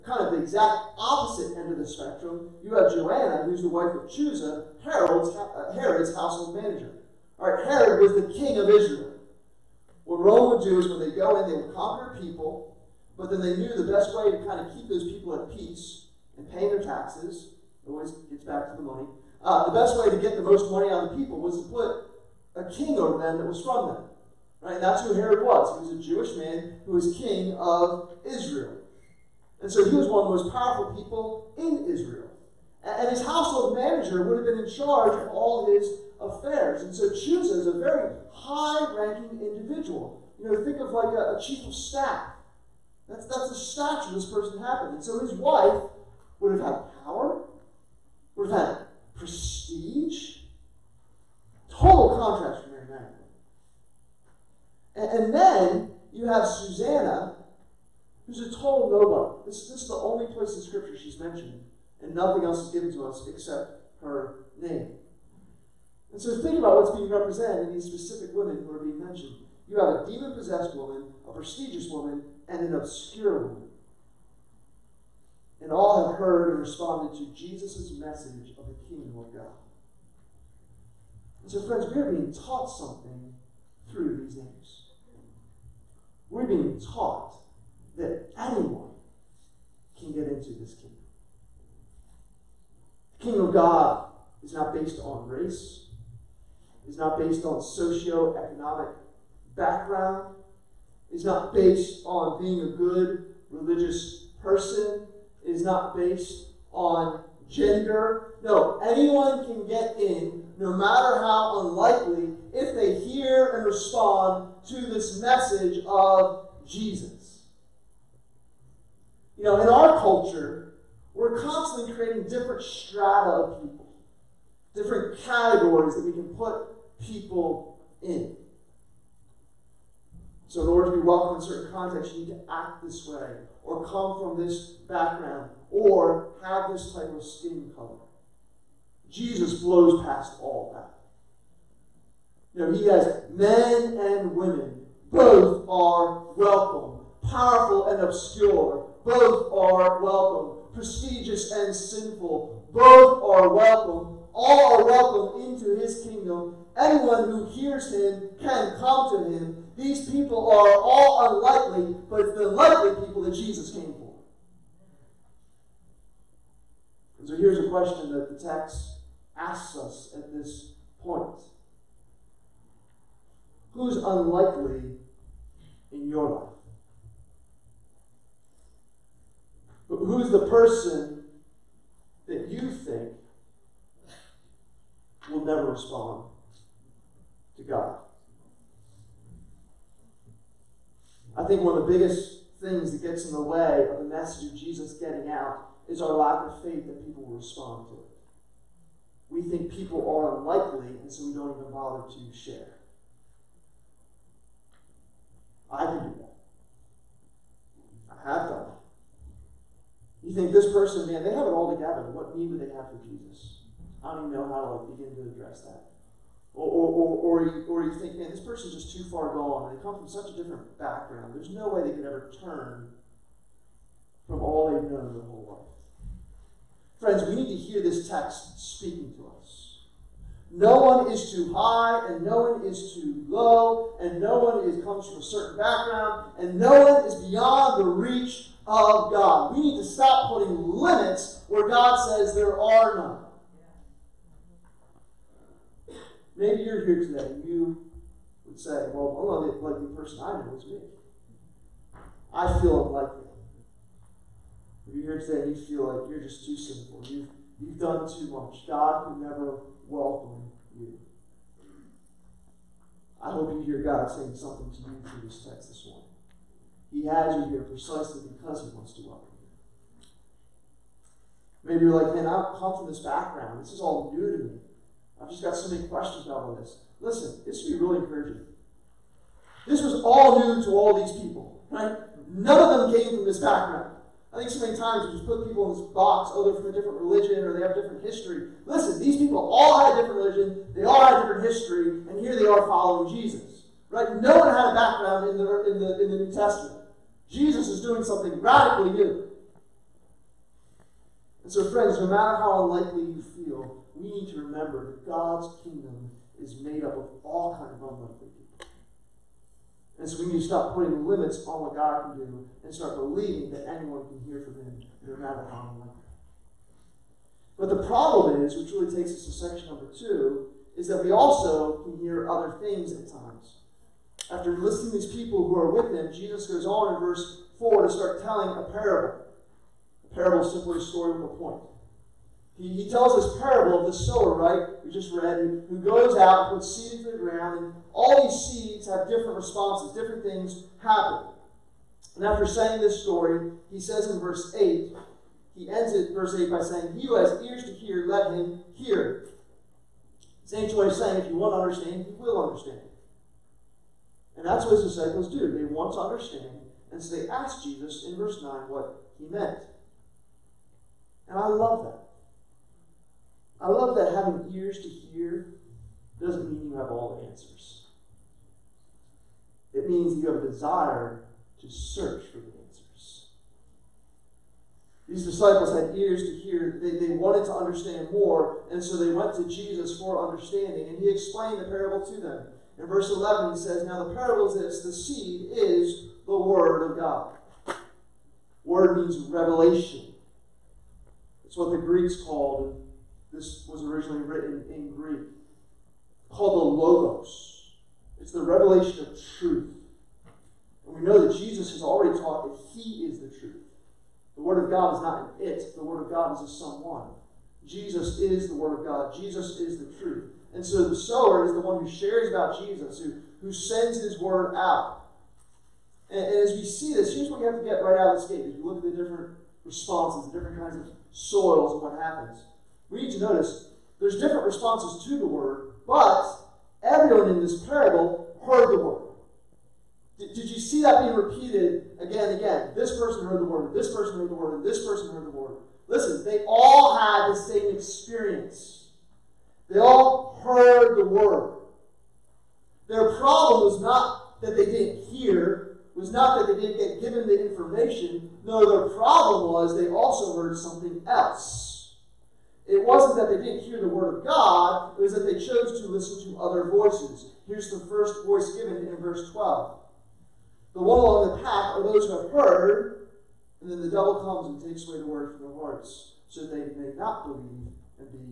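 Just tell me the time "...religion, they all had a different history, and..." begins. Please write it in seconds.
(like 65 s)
290 s.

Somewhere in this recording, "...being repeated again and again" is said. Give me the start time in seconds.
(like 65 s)
431 s.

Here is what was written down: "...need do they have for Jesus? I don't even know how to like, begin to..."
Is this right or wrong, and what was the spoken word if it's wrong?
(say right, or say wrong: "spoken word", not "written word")
right.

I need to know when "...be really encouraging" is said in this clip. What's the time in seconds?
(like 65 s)
277 s.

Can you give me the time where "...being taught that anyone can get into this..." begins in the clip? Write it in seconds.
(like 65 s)
86 s.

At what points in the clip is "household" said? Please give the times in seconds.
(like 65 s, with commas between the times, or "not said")
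6 s, 33 s.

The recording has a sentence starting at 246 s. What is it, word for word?
Maybe you're here today and you would say, Well, I'm not the unlikely person I know is me.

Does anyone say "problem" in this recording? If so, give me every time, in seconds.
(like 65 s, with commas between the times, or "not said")
317 s, 443 s, 448 s.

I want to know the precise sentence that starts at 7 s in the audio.
All right, Herod was the king of Israel.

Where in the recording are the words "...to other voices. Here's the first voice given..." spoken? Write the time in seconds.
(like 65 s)
456 s.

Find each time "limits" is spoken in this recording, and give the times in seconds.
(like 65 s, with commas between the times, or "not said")
240 s, 311 s.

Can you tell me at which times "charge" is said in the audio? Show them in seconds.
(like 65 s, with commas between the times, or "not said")
34 s.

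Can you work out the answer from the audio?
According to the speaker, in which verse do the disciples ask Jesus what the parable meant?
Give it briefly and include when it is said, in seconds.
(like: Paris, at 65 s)
Verse 9, at 358 s.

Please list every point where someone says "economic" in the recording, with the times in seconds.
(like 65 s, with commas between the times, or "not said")
97 s.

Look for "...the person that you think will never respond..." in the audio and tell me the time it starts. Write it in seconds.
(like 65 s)
180 s.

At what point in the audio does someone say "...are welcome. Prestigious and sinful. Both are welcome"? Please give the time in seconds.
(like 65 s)
149 s.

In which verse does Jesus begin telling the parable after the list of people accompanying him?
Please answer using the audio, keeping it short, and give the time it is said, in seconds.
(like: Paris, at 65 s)
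Verse 4, at 326 s.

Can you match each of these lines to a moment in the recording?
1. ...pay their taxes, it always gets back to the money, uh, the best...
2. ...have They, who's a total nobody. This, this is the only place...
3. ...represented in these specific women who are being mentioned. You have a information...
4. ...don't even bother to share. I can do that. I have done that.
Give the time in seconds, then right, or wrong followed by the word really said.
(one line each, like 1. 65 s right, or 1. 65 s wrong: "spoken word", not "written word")
1. 16 s right
2. 56 s wrong: "Susanna", not "They"
3. 67 s wrong: "demon", not "information"
4. 201 s right.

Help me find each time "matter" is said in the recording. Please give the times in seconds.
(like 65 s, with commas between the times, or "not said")
110 s, 302 s, 315 s.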